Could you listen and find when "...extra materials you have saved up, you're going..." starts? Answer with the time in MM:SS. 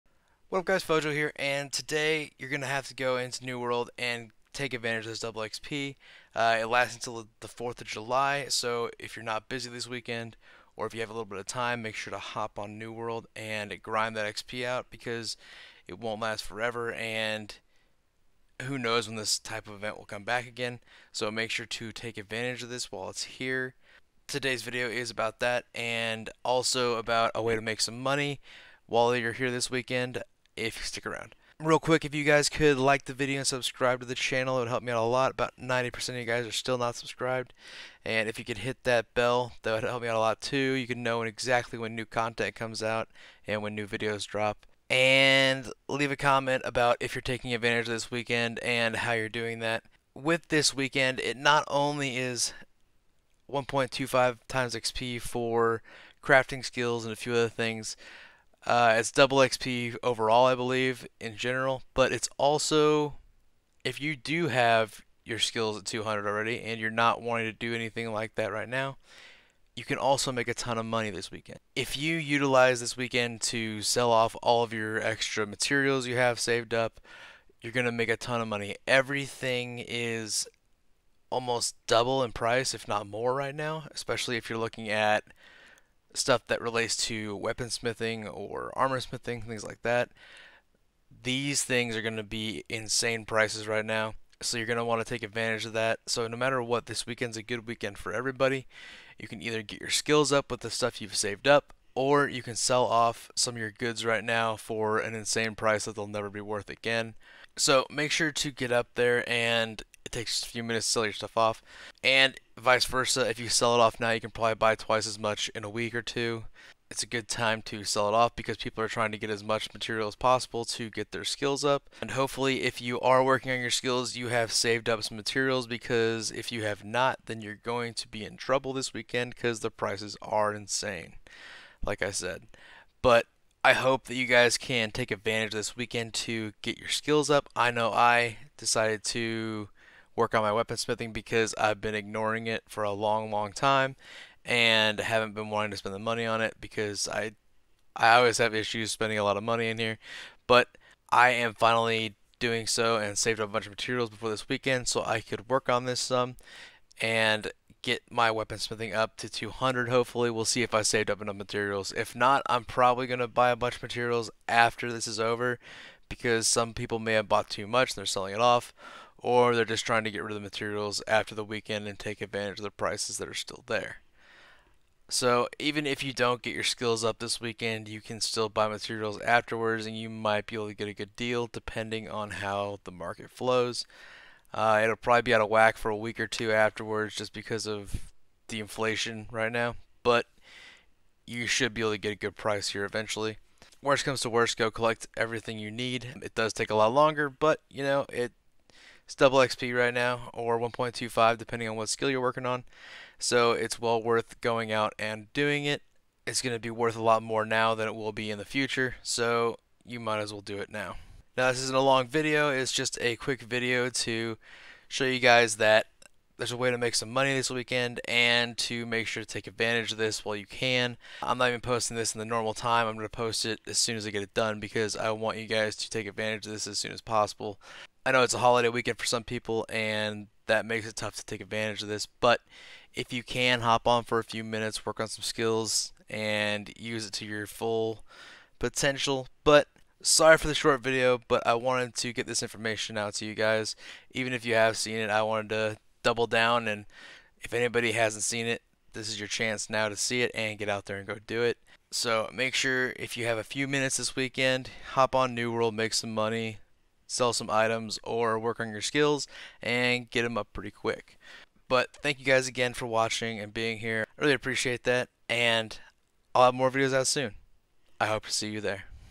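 01:15.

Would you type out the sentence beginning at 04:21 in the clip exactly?
But thank you guys again for watching and being here.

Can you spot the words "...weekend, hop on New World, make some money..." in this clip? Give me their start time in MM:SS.
04:14.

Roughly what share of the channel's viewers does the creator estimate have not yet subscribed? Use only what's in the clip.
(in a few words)
90%.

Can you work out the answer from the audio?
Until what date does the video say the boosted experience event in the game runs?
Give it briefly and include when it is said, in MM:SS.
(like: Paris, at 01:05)
4th of July, at 00:07.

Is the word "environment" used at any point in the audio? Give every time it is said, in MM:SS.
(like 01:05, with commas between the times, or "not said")
not said.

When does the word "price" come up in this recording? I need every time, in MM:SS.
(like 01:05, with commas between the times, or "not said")
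01:22, 01:33, 01:45, 02:09, 02:52, 03:12.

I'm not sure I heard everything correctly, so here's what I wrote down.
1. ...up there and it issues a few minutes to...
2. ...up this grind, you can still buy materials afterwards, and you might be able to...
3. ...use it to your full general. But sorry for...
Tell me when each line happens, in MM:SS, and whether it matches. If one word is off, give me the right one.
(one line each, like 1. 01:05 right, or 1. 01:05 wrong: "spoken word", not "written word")
1. 01:48 wrong: "takes", not "issues"
2. 02:57 wrong: "weekend", not "grind"
3. 03:56 wrong: "potential", not "general".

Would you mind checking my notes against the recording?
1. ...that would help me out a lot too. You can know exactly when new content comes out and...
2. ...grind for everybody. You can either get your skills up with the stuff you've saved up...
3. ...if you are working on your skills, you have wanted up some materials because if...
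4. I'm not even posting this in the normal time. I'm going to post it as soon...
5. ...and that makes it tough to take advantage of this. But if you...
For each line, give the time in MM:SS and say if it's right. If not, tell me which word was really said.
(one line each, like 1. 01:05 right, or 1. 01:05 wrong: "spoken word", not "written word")
1. 00:39 right
2. 01:37 wrong: "weekend", not "grind"
3. 02:02 wrong: "saved", not "wanted"
4. 03:41 right
5. 03:49 right.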